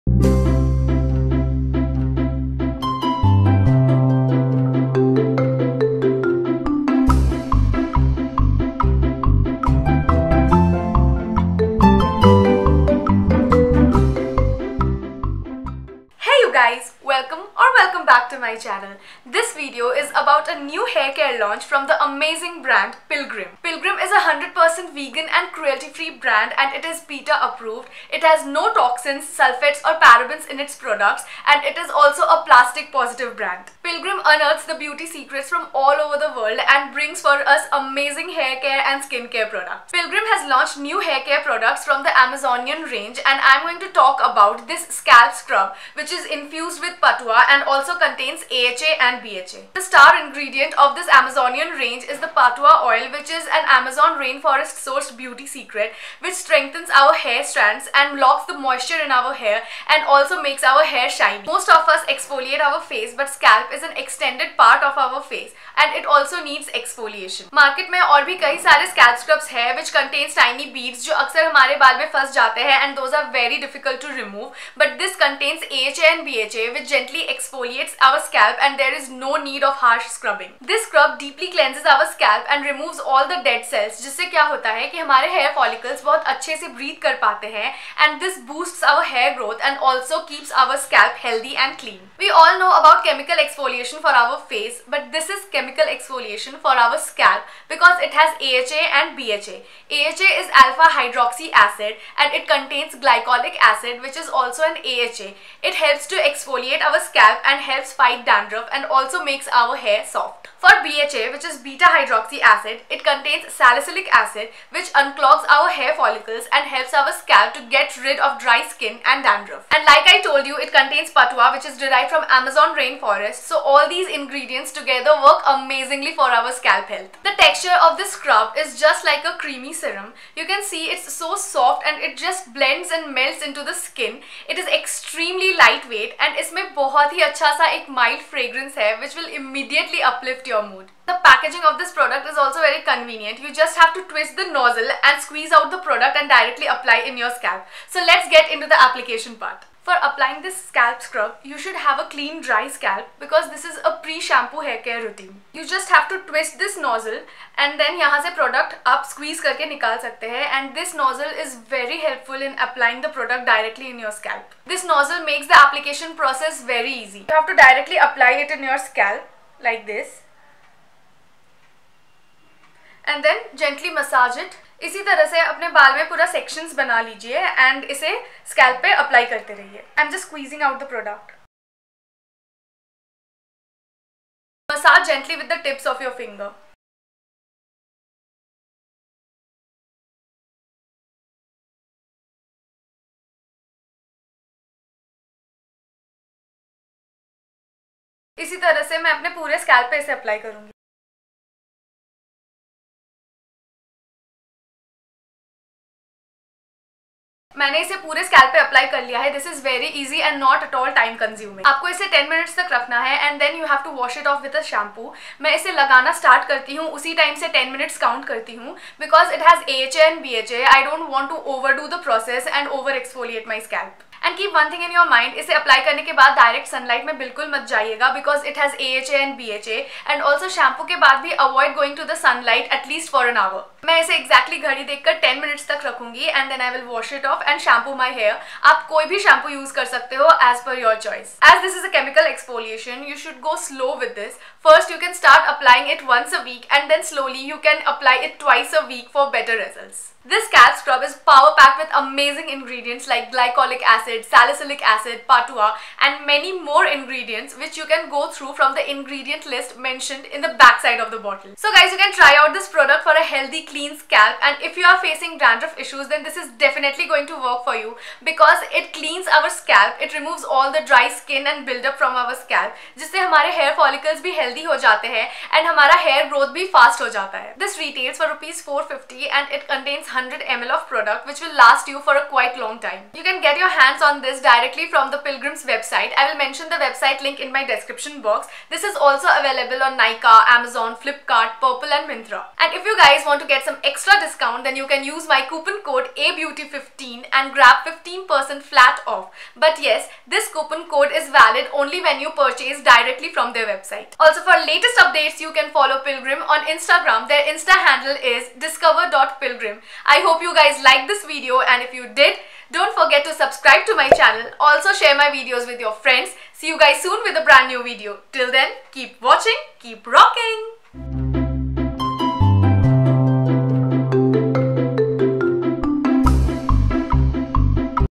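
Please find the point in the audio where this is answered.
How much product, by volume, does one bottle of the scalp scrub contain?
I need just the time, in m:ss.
4:40.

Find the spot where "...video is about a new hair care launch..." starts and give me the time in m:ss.
0:19.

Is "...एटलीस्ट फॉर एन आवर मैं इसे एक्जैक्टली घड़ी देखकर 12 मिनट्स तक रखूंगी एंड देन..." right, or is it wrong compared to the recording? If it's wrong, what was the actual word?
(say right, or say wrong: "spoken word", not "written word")
wrong: "10", not "12".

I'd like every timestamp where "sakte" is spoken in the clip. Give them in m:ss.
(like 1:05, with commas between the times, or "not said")
2:40.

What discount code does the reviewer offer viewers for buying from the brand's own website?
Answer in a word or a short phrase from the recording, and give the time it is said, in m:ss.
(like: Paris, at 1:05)
ABEAUTY15, at 4:56.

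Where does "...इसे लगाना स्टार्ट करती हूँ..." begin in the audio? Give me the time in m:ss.
3:35.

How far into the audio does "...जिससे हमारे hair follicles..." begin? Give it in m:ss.
4:32.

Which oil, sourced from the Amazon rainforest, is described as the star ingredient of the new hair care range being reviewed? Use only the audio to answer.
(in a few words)
Patua oil.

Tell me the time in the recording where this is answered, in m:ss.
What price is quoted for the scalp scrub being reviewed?
4:38.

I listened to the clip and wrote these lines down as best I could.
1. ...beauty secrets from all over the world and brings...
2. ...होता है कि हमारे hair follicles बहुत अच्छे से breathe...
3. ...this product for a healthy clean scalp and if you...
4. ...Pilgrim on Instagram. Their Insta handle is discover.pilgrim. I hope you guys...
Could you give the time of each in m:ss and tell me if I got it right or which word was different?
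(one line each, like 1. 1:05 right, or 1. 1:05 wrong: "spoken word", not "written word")
1. 0:34 right
2. 1:24 right
3. 4:22 right
4. 5:06 right.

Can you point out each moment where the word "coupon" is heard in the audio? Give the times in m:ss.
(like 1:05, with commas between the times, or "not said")
4:55, 5:00.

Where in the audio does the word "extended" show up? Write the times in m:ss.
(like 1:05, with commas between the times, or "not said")
1:03.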